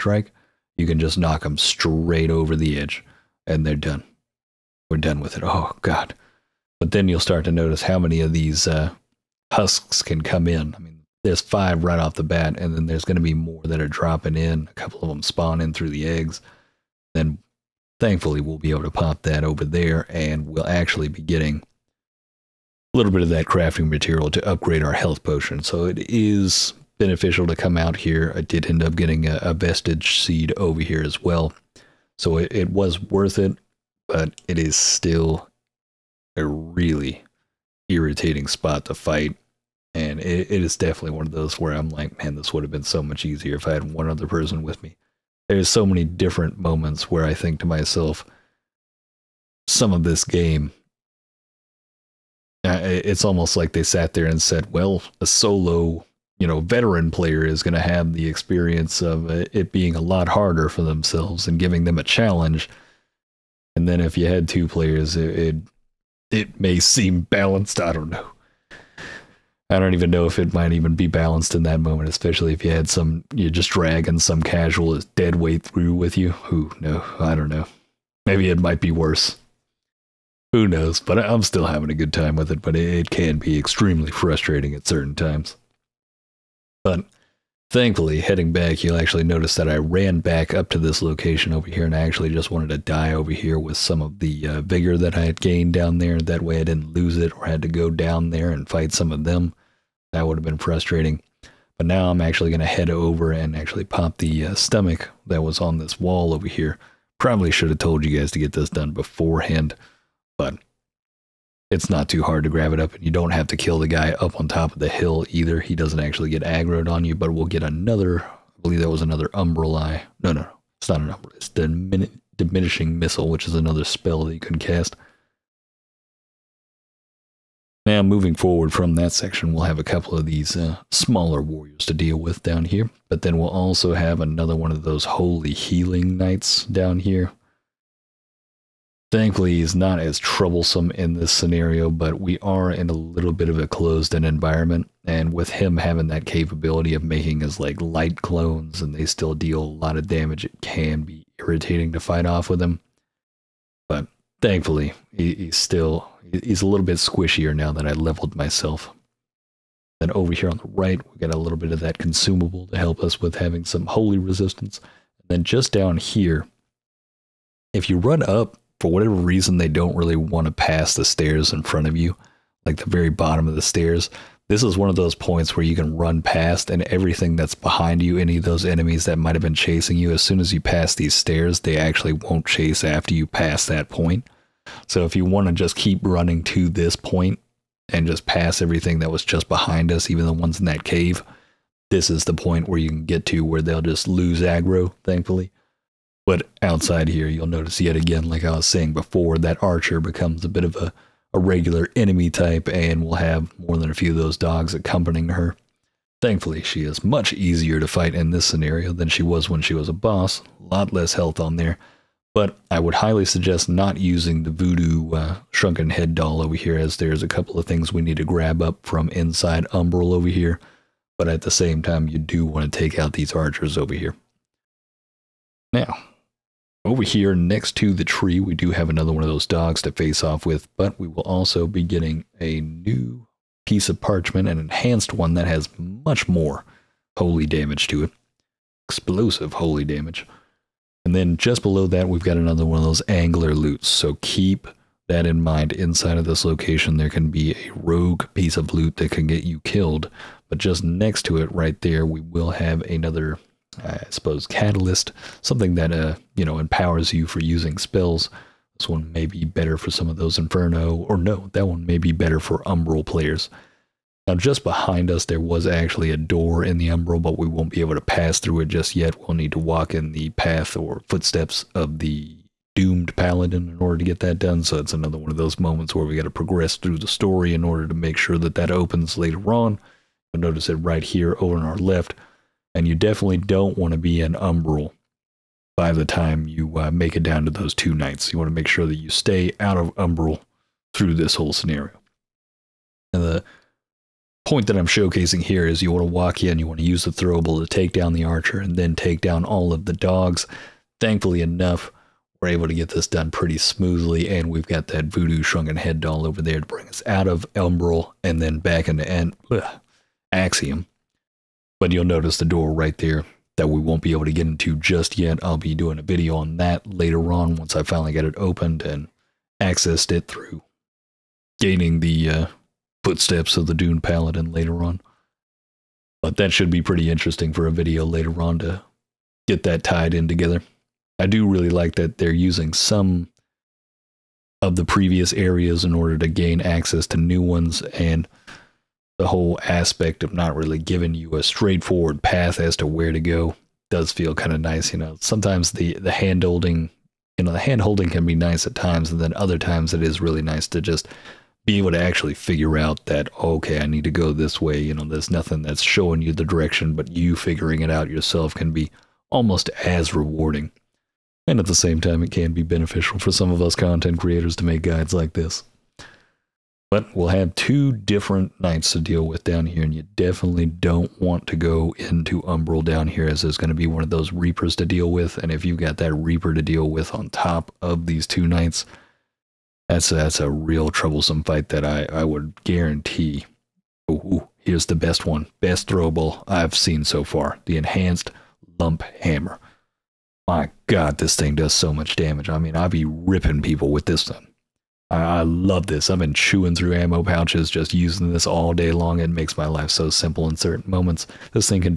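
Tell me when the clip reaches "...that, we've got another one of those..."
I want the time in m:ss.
4:01.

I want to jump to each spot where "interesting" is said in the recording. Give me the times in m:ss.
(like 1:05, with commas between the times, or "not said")
5:27.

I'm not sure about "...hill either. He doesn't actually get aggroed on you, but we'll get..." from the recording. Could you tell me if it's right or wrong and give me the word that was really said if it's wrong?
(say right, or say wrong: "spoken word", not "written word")
right.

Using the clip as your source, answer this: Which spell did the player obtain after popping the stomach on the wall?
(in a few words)
Diminishing Missile.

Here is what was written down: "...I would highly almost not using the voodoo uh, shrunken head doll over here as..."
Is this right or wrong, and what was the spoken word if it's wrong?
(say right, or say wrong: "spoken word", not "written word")
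wrong: "suggest", not "almost".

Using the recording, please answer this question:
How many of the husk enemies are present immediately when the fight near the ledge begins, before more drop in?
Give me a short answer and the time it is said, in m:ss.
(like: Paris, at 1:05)
5, at 0:11.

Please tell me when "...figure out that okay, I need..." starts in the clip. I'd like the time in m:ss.
5:52.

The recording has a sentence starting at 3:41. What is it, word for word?
But at the same time, you do want to take out these archers over here.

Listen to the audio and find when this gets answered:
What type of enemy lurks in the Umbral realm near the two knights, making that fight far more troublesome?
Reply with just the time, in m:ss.
6:14.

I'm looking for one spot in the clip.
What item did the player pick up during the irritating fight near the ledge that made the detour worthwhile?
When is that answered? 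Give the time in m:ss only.
0:29.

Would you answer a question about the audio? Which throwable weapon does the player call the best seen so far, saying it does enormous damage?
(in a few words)
Enhanced Lump Hammer.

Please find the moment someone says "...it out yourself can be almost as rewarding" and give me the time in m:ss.
5:57.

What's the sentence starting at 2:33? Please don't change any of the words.
But thankfully, he, he's still he's a little bit squishier now that I leveled myself.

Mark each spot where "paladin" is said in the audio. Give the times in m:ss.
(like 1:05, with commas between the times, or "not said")
4:33, 5:24.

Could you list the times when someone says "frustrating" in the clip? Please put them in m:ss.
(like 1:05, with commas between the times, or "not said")
1:24, 1:40.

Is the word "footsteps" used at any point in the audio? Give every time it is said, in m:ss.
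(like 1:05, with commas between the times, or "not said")
4:31, 5:23.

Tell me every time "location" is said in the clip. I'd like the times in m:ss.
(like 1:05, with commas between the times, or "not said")
1:31, 4:06.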